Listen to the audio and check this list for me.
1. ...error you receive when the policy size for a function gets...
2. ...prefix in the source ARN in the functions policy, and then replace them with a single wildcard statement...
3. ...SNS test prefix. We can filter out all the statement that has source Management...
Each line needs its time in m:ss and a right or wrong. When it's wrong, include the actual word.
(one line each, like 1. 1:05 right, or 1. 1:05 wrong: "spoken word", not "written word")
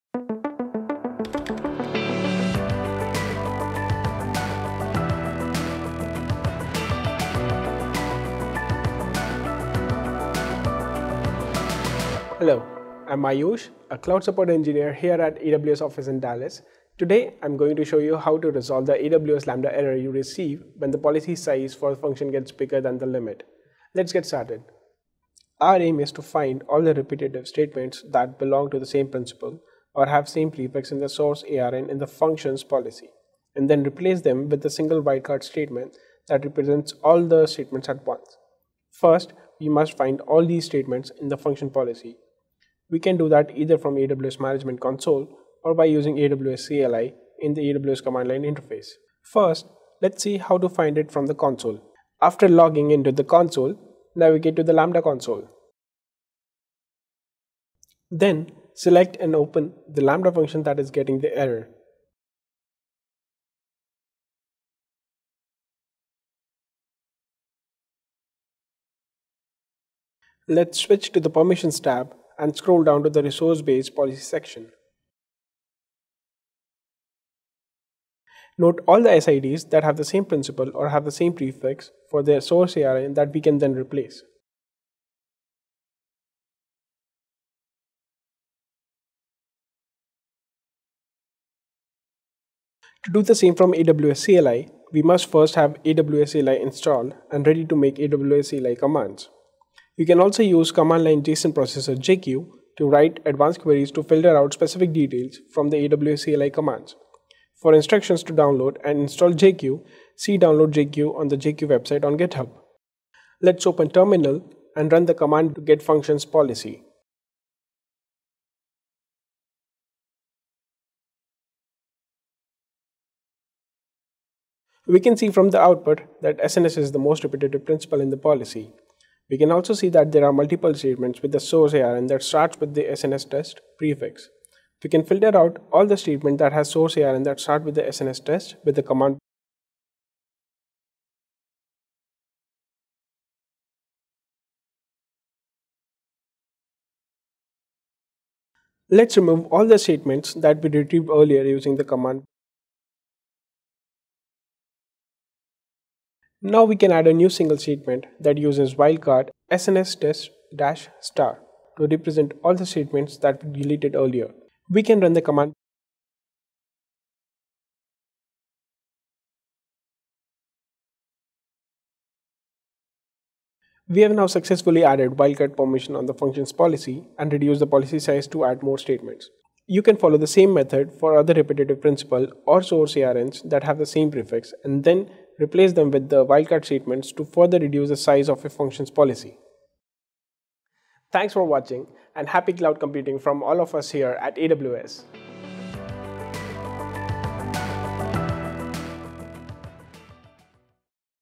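1. 0:19 right
2. 0:30 right
3. 2:12 wrong: "ARN", not "Management".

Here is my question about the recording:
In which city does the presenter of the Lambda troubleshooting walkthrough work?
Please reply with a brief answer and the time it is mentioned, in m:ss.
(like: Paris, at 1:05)
Dallas, at 0:16.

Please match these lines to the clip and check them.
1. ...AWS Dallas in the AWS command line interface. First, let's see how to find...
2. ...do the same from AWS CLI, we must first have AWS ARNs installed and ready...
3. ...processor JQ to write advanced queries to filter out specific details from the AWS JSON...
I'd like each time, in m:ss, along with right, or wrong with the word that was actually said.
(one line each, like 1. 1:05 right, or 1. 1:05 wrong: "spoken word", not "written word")
1. 0:46 wrong: "CLI", not "Dallas"
2. 1:33 wrong: "CLI", not "ARNs"
3. 1:41 wrong: "CLI", not "JSON".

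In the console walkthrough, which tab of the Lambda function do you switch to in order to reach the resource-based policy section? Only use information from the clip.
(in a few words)
Permissions.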